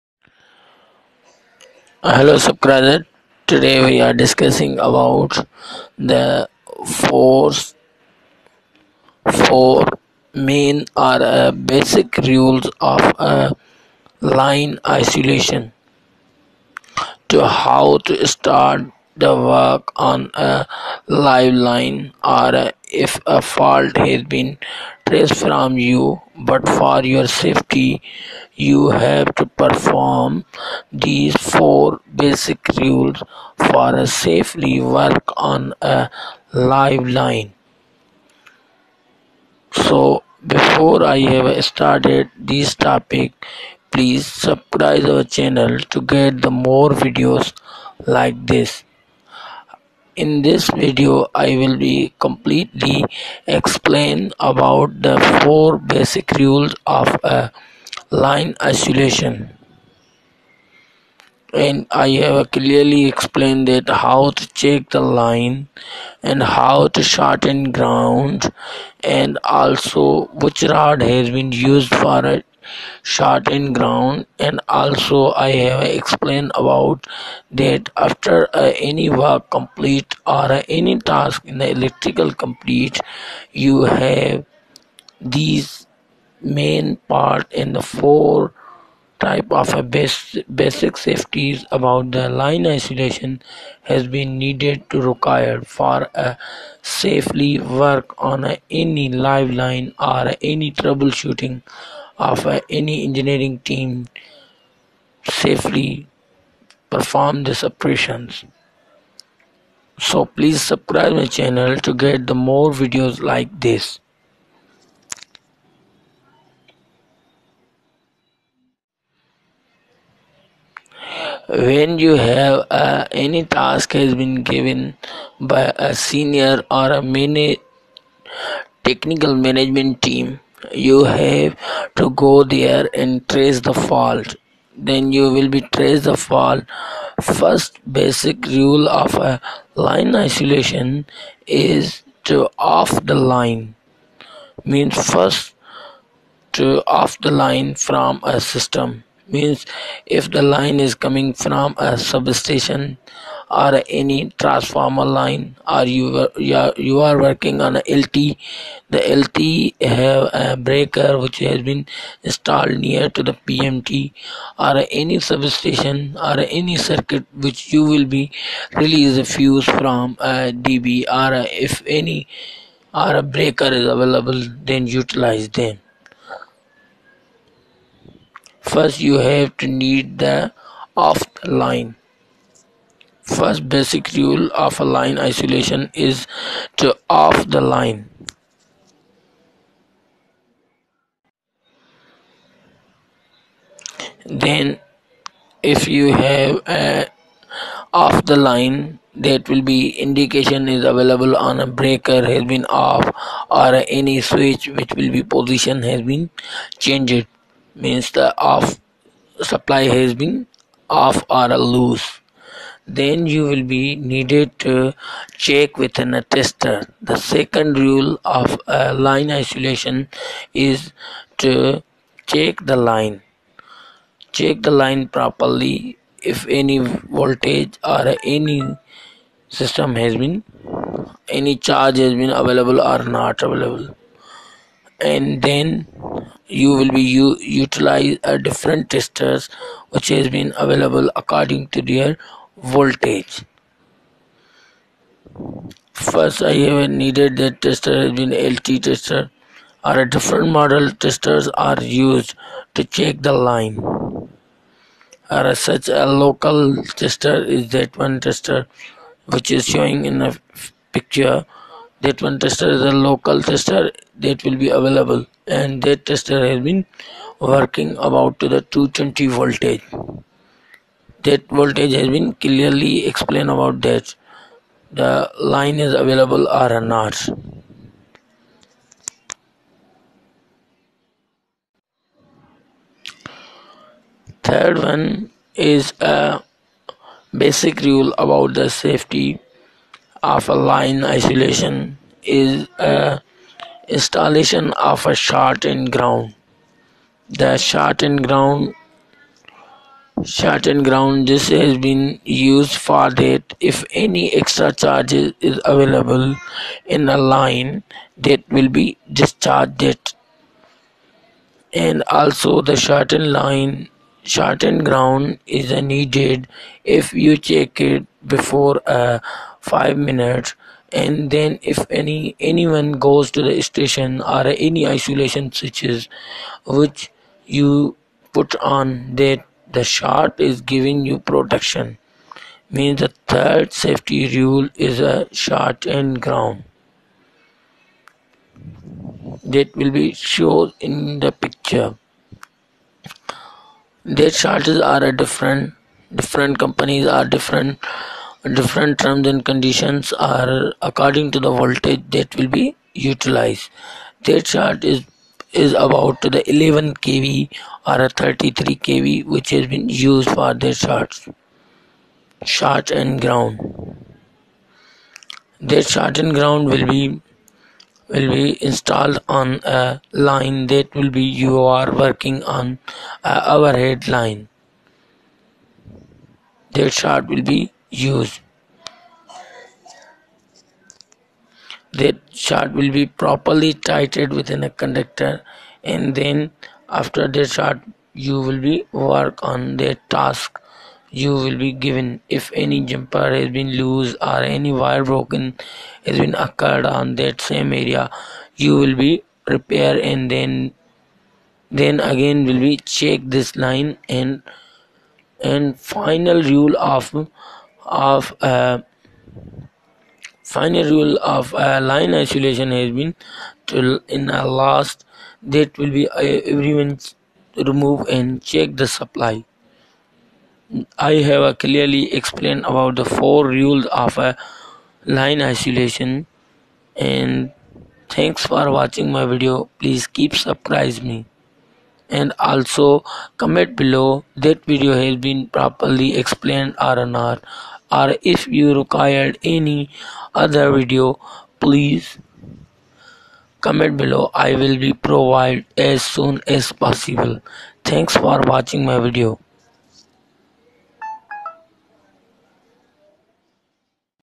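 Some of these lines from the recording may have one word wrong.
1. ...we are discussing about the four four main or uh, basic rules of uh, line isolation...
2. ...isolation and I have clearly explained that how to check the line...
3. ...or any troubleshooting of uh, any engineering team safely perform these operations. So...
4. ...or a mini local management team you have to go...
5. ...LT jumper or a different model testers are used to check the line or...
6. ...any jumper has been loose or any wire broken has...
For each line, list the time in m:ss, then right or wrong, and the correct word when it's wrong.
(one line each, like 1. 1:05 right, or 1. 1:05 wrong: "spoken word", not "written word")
1. 0:03 right
2. 0:58 right
3. 1:39 right
4. 2:06 wrong: "technical", not "local"
5. 4:08 wrong: "tester", not "jumper"
6. 6:32 right.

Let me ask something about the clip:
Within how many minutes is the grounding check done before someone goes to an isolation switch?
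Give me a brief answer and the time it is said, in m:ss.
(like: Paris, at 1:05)
5 minutes, at 5:19.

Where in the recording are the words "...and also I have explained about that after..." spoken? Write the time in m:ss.
1:14.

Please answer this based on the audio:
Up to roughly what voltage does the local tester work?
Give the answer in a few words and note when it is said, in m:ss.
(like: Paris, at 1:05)
220 volts, at 4:28.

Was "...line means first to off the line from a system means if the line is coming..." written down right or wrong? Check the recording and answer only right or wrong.
right.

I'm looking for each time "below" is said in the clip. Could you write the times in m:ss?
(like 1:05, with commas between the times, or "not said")
7:13, 7:24.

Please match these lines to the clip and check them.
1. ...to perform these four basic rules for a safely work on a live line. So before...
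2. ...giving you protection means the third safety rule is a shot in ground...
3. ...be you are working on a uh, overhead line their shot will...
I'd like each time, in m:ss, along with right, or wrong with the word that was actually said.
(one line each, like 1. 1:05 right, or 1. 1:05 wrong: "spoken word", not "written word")
1. 0:29 right
2. 5:30 right
3. 6:11 right.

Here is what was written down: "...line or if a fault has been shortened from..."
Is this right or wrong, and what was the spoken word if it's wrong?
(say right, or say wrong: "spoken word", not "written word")
wrong: "traced", not "shortened".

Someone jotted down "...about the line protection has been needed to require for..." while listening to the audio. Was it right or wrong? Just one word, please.
wrong.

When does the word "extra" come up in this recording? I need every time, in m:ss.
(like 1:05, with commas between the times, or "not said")
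5:04.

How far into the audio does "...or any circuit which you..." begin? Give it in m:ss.
2:46.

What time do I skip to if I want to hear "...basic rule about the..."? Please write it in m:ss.
4:47.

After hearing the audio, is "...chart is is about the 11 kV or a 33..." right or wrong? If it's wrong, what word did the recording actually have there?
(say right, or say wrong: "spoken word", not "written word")
right.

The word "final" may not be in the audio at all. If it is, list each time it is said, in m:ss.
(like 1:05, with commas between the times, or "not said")
6:45, 6:50.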